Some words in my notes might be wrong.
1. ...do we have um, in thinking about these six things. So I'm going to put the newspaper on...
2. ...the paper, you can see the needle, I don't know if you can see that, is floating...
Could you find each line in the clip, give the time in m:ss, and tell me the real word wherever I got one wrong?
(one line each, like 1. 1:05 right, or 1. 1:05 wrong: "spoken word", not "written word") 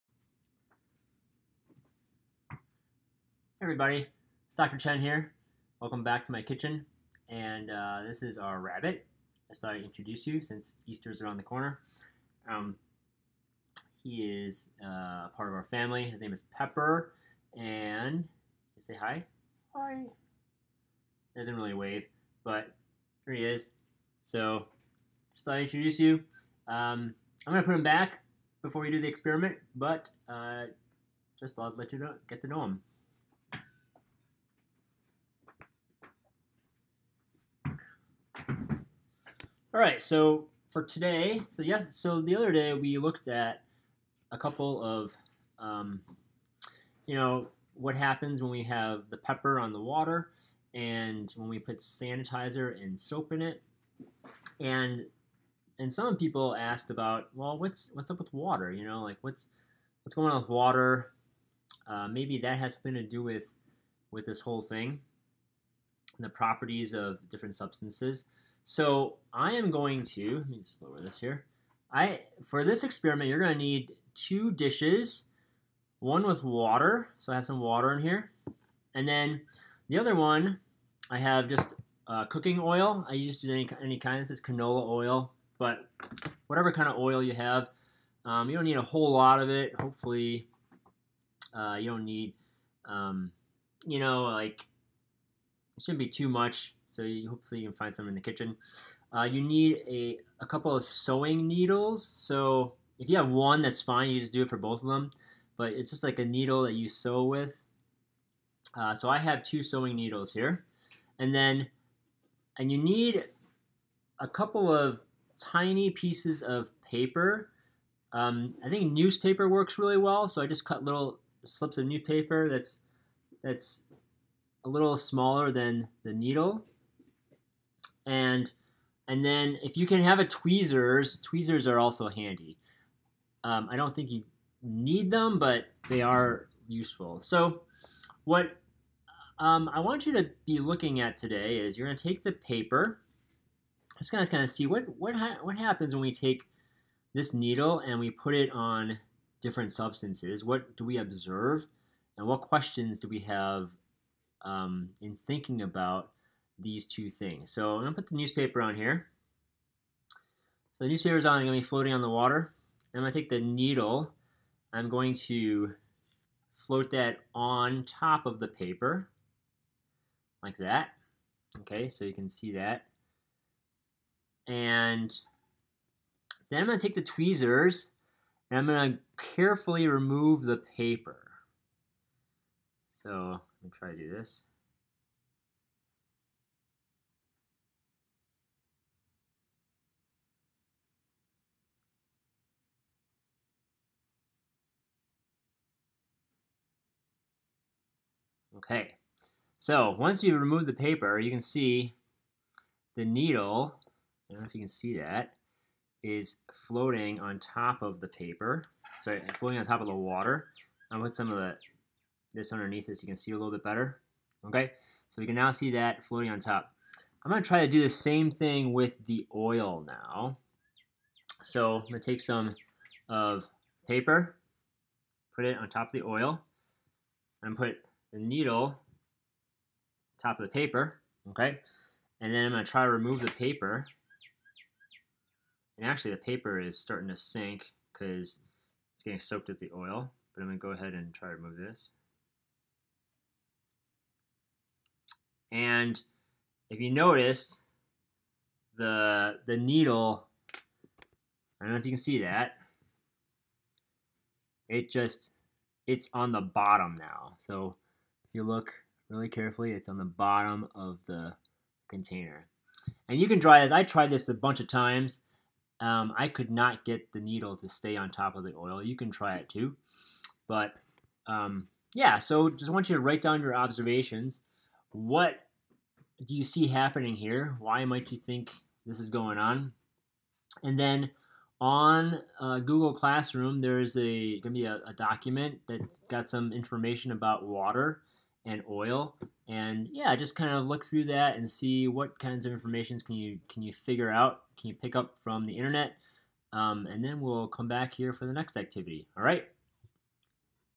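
1. 2:32 wrong: "two", not "six"
2. 3:20 right.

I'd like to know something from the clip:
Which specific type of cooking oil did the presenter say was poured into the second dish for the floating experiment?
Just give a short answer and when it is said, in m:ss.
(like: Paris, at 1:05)
canola oil, at 1:24.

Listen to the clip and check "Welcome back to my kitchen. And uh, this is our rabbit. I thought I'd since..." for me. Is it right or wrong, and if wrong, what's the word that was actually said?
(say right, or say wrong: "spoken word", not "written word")
wrong: "introduce", not "since".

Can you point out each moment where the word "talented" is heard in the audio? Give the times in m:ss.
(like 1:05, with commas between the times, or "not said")
not said.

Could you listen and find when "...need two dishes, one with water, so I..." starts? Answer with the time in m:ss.
1:13.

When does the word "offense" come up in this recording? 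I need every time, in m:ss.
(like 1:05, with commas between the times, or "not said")
not said.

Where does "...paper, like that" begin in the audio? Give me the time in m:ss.
2:48.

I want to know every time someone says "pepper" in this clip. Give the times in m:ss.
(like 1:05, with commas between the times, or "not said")
0:16, 0:49.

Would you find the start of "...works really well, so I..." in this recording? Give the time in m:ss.
1:59.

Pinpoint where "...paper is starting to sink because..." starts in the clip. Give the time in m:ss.
3:56.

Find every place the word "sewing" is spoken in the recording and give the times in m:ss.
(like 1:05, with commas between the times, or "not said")
1:40, 1:49.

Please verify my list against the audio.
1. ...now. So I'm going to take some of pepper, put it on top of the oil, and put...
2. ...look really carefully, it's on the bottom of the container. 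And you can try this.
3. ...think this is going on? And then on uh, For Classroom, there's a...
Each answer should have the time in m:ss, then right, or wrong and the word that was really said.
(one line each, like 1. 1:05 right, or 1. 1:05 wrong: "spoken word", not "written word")
1. 3:39 wrong: "paper", not "pepper"
2. 4:18 right
3. 4:38 wrong: "Google", not "For".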